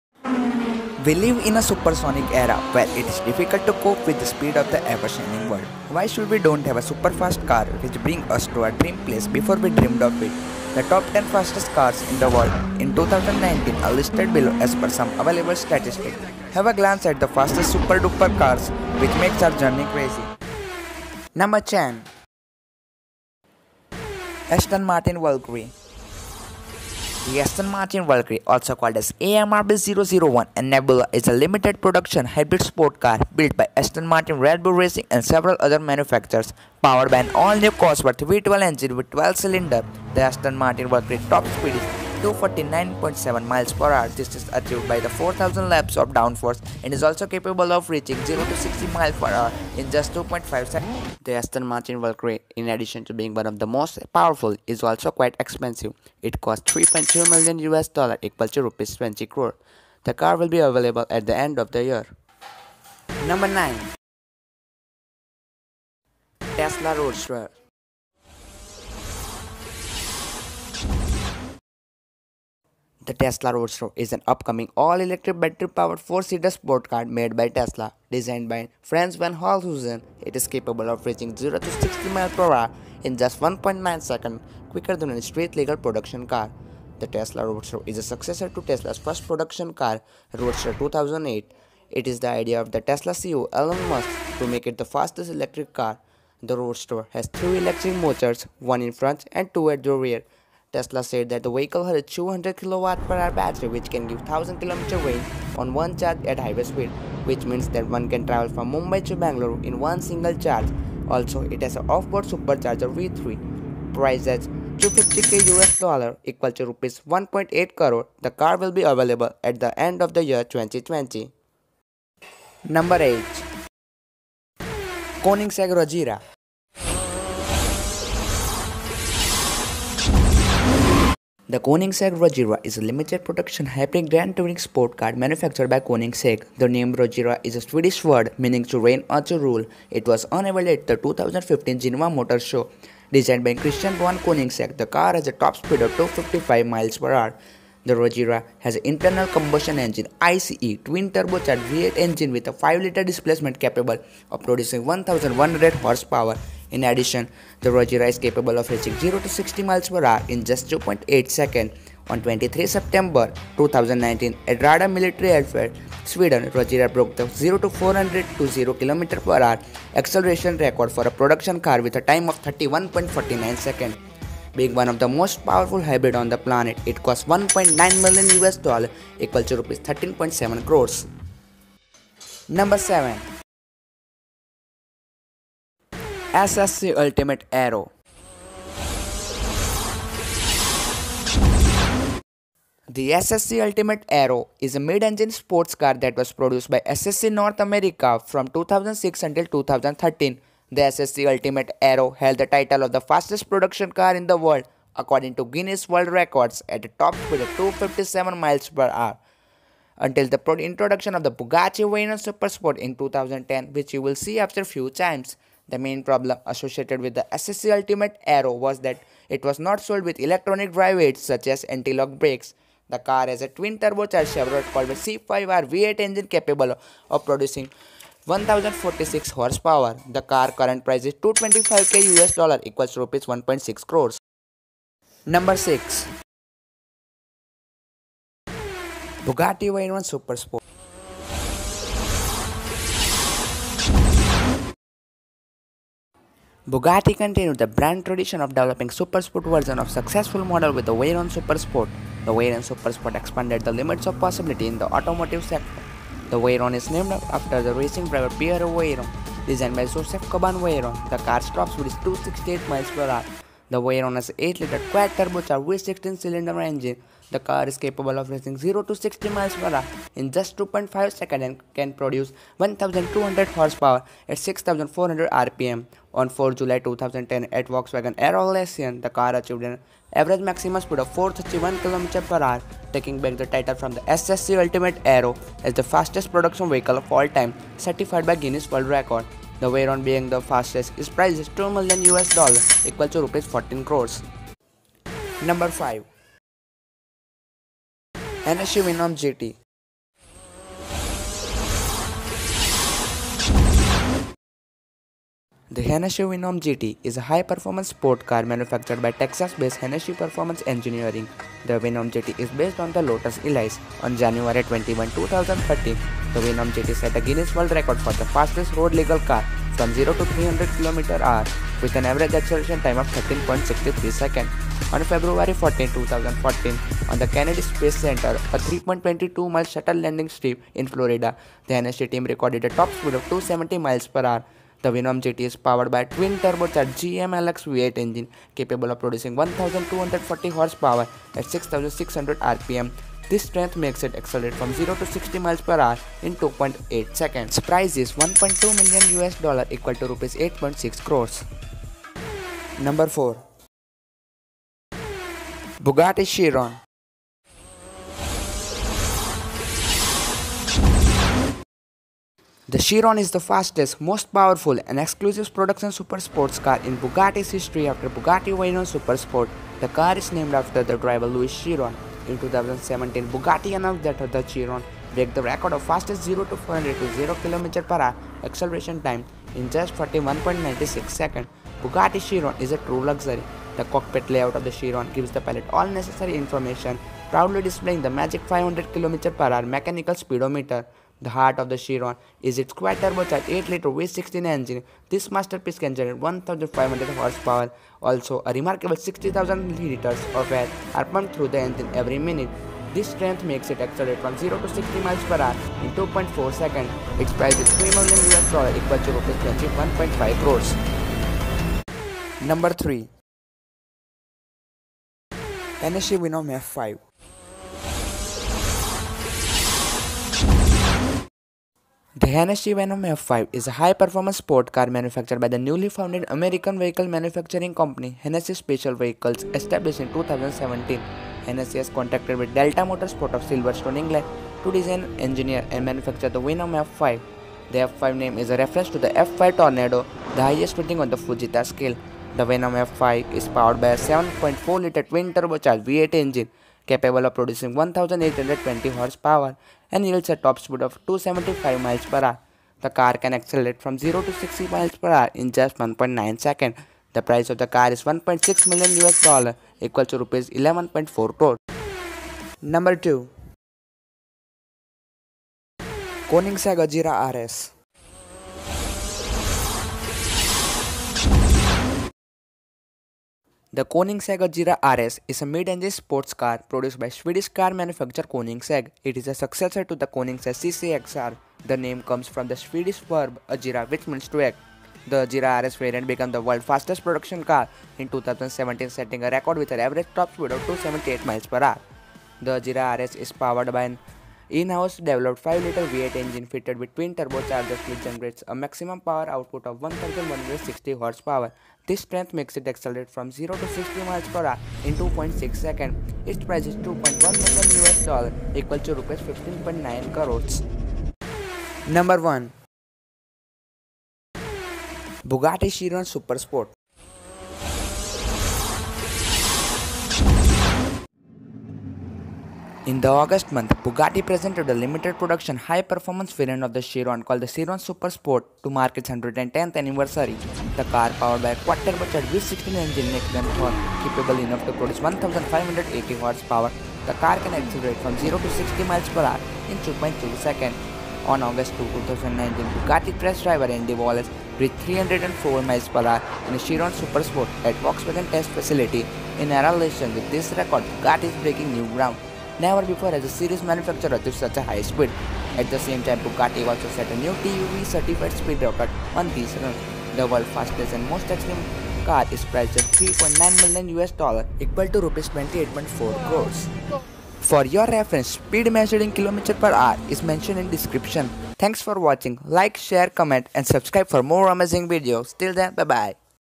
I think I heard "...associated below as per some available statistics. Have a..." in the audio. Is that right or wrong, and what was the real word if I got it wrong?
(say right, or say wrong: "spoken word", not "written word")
wrong: "listed", not "associated".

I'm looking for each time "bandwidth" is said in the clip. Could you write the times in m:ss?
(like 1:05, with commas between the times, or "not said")
not said.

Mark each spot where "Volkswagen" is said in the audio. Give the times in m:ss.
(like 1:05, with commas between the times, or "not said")
4:37, 9:07.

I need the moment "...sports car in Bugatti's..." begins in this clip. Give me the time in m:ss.
6:06.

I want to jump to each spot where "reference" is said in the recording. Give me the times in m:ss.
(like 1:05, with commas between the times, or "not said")
7:18, 9:27.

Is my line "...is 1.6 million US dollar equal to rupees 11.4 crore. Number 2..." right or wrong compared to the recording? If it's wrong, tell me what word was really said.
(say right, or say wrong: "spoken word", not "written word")
right.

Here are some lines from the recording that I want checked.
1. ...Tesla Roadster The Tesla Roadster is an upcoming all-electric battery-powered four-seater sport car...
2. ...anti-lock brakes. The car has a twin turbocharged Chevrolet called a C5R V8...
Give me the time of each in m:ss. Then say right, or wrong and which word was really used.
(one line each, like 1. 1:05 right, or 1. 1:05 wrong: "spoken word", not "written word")
1. 1:06 right
2. 3:41 right.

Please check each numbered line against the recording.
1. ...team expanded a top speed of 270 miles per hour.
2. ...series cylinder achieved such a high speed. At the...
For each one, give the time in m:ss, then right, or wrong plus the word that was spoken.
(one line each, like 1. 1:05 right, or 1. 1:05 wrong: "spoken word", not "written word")
1. 5:32 wrong: "recorded", not "expanded"
2. 9:13 wrong: "manufacturer", not "cylinder".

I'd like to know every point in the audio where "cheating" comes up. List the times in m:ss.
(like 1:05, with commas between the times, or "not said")
not said.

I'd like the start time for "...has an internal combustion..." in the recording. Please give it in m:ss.
2:28.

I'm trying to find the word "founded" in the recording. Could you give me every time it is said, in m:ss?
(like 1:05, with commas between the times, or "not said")
7:05.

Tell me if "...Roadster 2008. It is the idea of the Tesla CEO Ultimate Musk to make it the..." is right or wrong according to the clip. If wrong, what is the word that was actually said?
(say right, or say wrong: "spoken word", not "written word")
wrong: "Elon", not "Ultimate".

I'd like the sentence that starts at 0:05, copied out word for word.
Why should we don't have a super fast car which bring us to our dream place before we dreamed of it?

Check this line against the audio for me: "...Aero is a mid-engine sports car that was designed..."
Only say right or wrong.
wrong.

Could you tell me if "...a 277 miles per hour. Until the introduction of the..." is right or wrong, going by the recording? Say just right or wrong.
wrong.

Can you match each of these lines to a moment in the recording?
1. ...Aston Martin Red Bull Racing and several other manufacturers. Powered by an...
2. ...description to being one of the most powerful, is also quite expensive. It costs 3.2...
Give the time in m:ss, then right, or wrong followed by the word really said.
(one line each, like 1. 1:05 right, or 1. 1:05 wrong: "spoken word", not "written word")
1. 0:33 right
2. 0:52 wrong: "addition", not "description".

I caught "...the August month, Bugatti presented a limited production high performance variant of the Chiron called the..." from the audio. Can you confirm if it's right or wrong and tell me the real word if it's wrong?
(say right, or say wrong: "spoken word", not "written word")
right.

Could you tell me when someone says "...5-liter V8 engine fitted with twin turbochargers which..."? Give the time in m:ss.
8:15.